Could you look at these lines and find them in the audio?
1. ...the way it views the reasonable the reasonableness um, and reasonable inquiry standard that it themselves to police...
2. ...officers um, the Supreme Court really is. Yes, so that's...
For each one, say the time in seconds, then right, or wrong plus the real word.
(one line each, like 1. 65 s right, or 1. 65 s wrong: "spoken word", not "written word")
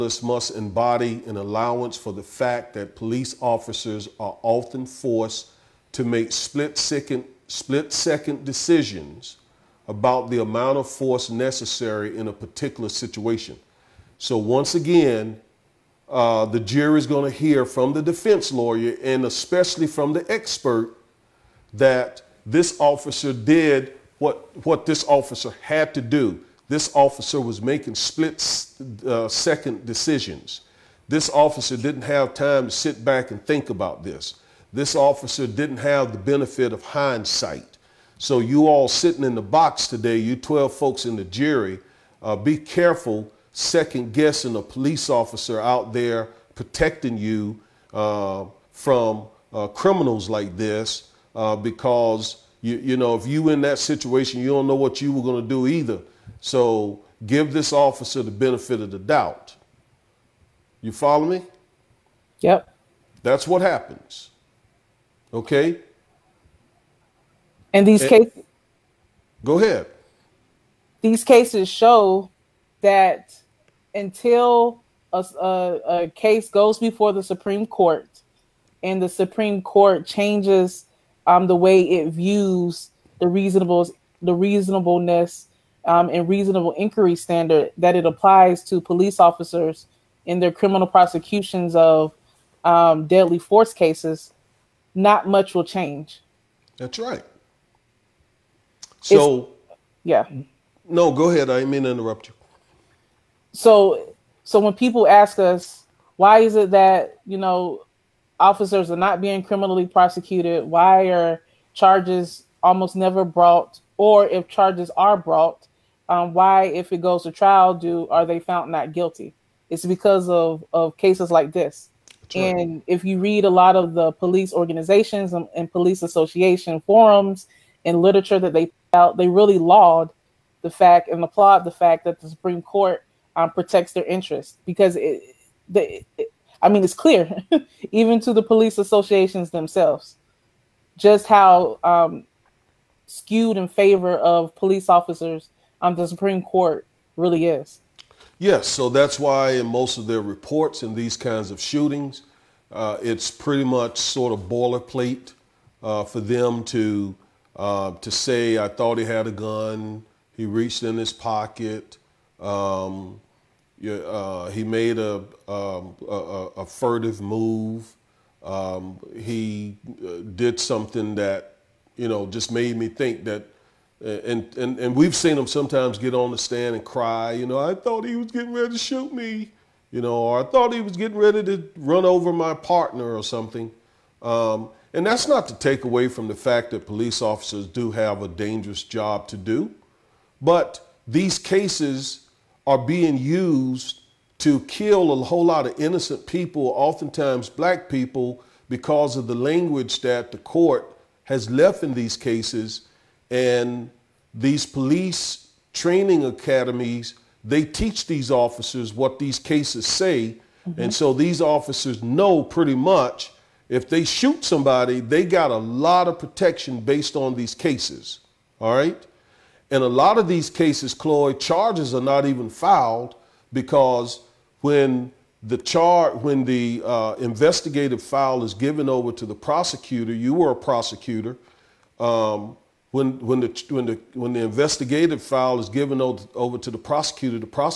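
1. 81 s wrong: "applies", not "themselves"
2. 144 s right.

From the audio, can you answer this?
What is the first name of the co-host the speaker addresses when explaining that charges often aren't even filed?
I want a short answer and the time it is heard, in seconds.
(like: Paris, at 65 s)
Chloe, at 220 s.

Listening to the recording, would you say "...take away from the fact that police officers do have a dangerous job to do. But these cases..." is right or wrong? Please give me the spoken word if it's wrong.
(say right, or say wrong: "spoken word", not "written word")
right.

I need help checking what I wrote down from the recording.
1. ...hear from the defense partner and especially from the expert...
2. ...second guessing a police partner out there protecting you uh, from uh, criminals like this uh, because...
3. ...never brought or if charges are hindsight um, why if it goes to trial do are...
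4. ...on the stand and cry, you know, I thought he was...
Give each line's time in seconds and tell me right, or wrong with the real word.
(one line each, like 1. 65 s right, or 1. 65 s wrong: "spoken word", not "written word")
1. 17 s wrong: "lawyer", not "partner"
2. 43 s wrong: "officer", not "partner"
3. 112 s wrong: "brought", not "hindsight"
4. 176 s right.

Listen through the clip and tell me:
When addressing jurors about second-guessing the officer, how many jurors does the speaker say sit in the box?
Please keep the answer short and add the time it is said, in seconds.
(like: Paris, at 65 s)
12, at 40 s.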